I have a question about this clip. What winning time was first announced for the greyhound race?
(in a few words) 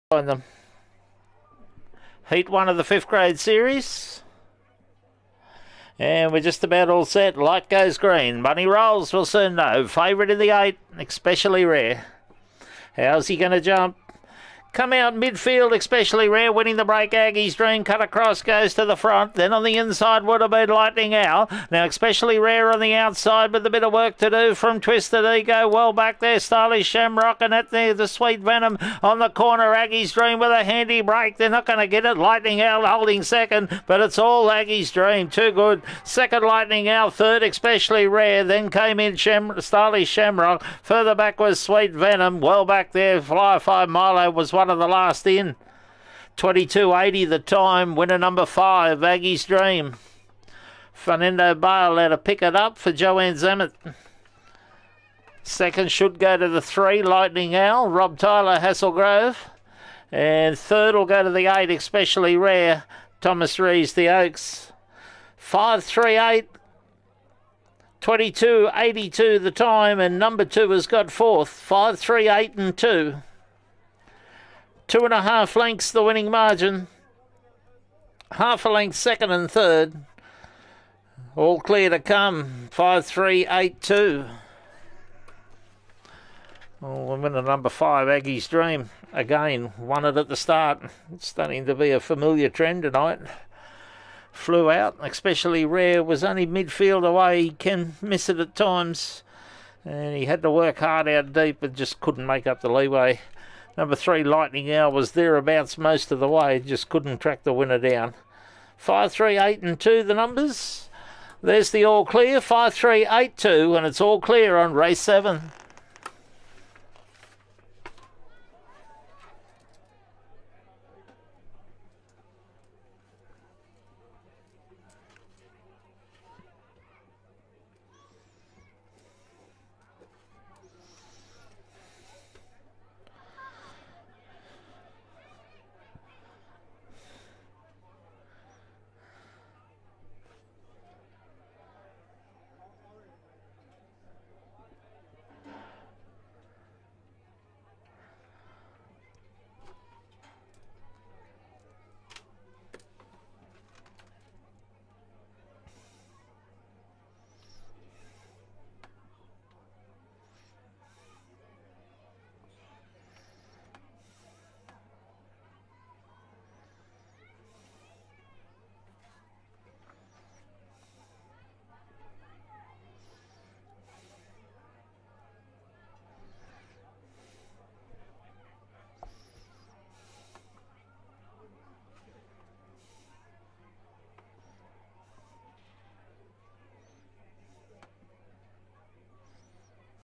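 22.80.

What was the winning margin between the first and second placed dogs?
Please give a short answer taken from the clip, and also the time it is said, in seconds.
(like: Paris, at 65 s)
2 and a half lengths, at 74 s.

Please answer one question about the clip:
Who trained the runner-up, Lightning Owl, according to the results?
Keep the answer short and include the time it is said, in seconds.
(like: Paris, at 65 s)
Rob Tyler, at 57 s.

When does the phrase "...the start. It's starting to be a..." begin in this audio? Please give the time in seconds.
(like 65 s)
90 s.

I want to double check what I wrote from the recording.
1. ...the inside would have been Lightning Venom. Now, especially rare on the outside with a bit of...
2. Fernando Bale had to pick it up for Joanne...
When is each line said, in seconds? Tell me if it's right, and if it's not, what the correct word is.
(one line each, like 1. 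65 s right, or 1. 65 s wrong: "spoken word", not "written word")
1. 19 s wrong: "Owl", not "Venom"
2. 50 s right.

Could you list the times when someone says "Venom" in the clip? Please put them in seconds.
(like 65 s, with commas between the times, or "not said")
28 s, 41 s.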